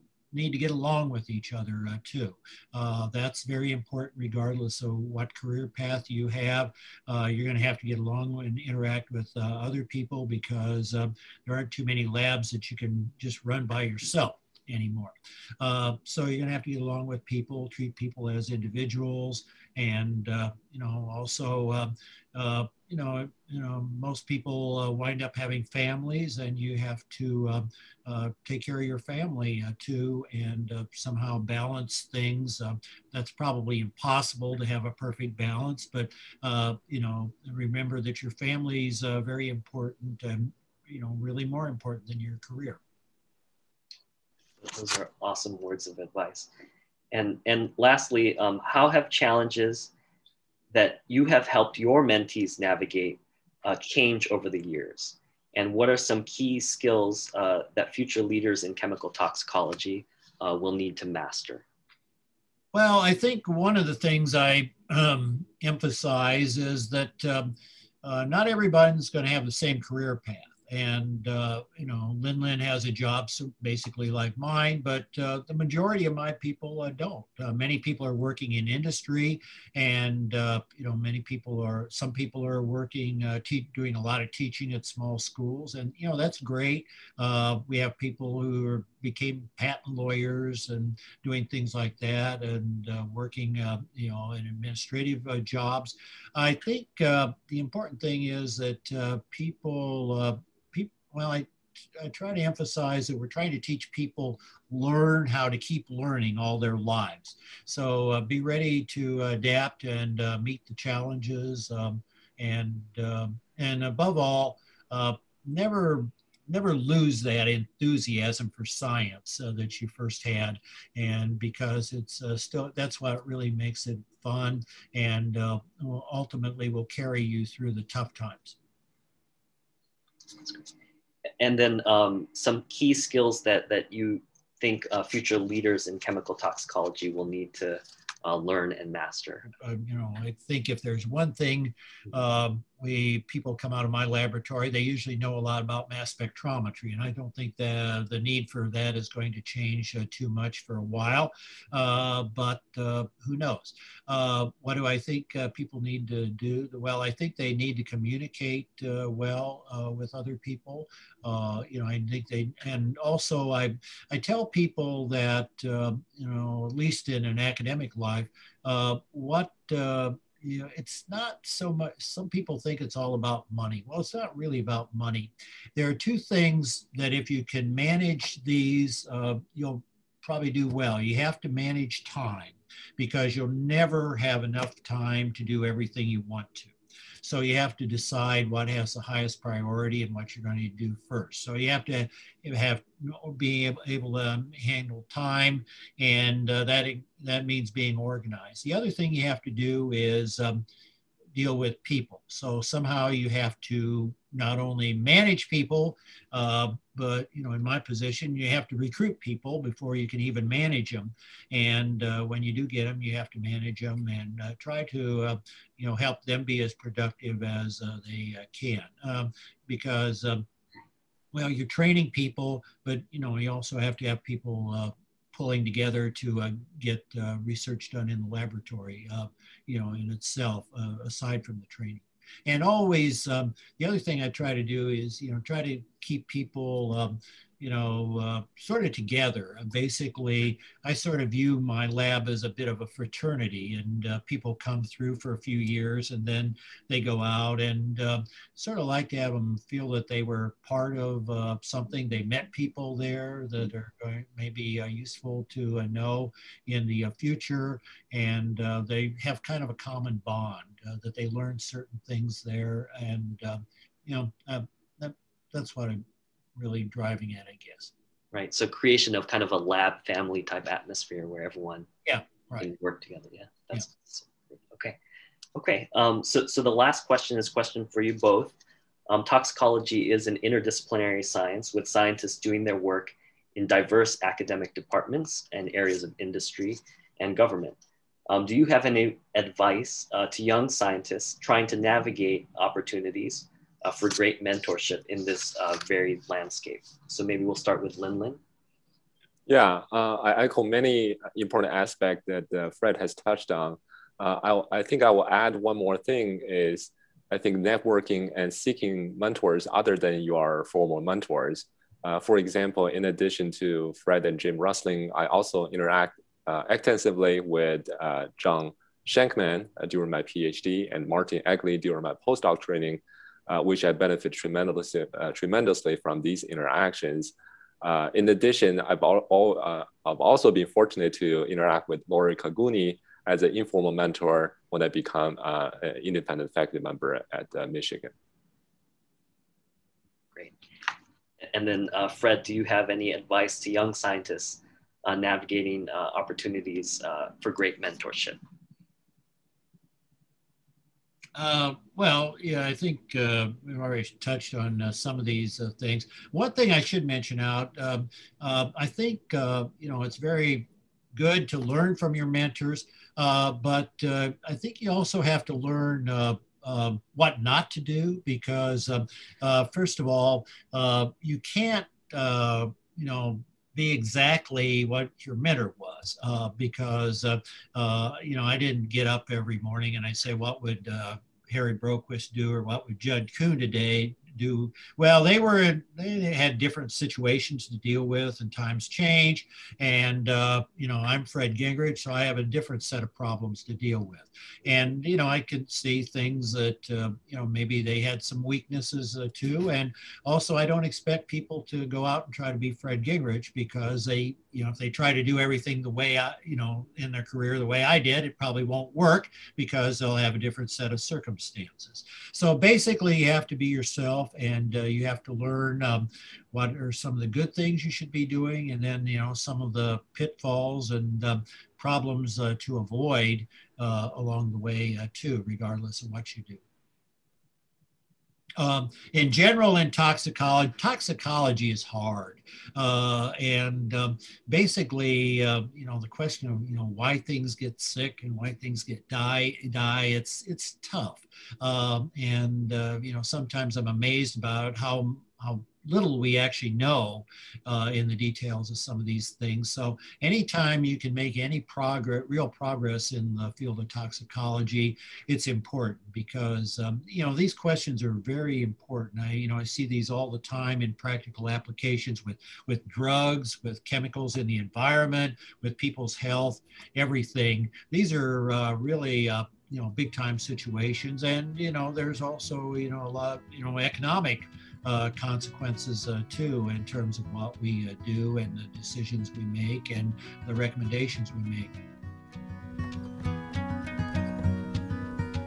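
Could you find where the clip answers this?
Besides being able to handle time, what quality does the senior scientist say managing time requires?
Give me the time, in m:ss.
3:17.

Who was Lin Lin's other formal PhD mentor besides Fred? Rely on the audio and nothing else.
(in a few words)
Jim Rusling.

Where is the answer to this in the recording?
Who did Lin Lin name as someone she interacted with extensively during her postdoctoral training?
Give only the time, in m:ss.
5:21.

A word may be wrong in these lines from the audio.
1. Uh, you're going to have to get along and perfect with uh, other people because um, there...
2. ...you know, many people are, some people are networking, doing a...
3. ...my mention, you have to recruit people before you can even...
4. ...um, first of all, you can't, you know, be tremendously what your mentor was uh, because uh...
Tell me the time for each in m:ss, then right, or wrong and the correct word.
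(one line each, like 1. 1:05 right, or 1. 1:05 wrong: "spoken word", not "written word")
1. 0:07 wrong: "interact", not "perfect"
2. 1:20 wrong: "working", not "networking"
3. 3:27 wrong: "position", not "mention"
4. 6:08 wrong: "exactly", not "tremendously".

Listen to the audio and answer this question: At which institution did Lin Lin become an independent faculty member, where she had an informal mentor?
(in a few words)
Michigan.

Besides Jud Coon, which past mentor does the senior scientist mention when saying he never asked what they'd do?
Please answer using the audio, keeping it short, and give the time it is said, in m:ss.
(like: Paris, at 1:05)
Harry Broquist, at 6:21.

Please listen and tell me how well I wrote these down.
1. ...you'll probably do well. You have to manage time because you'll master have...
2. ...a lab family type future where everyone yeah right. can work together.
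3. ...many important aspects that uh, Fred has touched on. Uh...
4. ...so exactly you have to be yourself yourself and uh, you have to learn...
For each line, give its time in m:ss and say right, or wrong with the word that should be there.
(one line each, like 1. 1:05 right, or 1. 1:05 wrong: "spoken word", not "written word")
1. 2:59 wrong: "never", not "master"
2. 4:29 wrong: "atmosphere", not "future"
3. 5:00 right
4. 6:52 wrong: "basically", not "exactly".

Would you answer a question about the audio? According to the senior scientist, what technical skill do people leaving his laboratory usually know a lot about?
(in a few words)
Mass spectrometry.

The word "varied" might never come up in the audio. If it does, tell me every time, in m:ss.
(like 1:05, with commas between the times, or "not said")
4:55.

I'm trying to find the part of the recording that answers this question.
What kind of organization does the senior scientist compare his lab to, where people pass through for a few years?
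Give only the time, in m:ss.
4:02.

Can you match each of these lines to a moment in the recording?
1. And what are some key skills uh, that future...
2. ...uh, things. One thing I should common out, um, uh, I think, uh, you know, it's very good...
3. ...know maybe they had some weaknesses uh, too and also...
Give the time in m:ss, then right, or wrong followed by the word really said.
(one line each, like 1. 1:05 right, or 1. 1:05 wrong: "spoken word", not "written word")
1. 0:55 right
2. 5:55 wrong: "mention", not "common"
3. 6:37 right.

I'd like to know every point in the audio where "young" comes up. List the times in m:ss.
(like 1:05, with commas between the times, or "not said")
4:50, 5:43.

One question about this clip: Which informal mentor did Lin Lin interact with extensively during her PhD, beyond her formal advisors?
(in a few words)
John Schenkman.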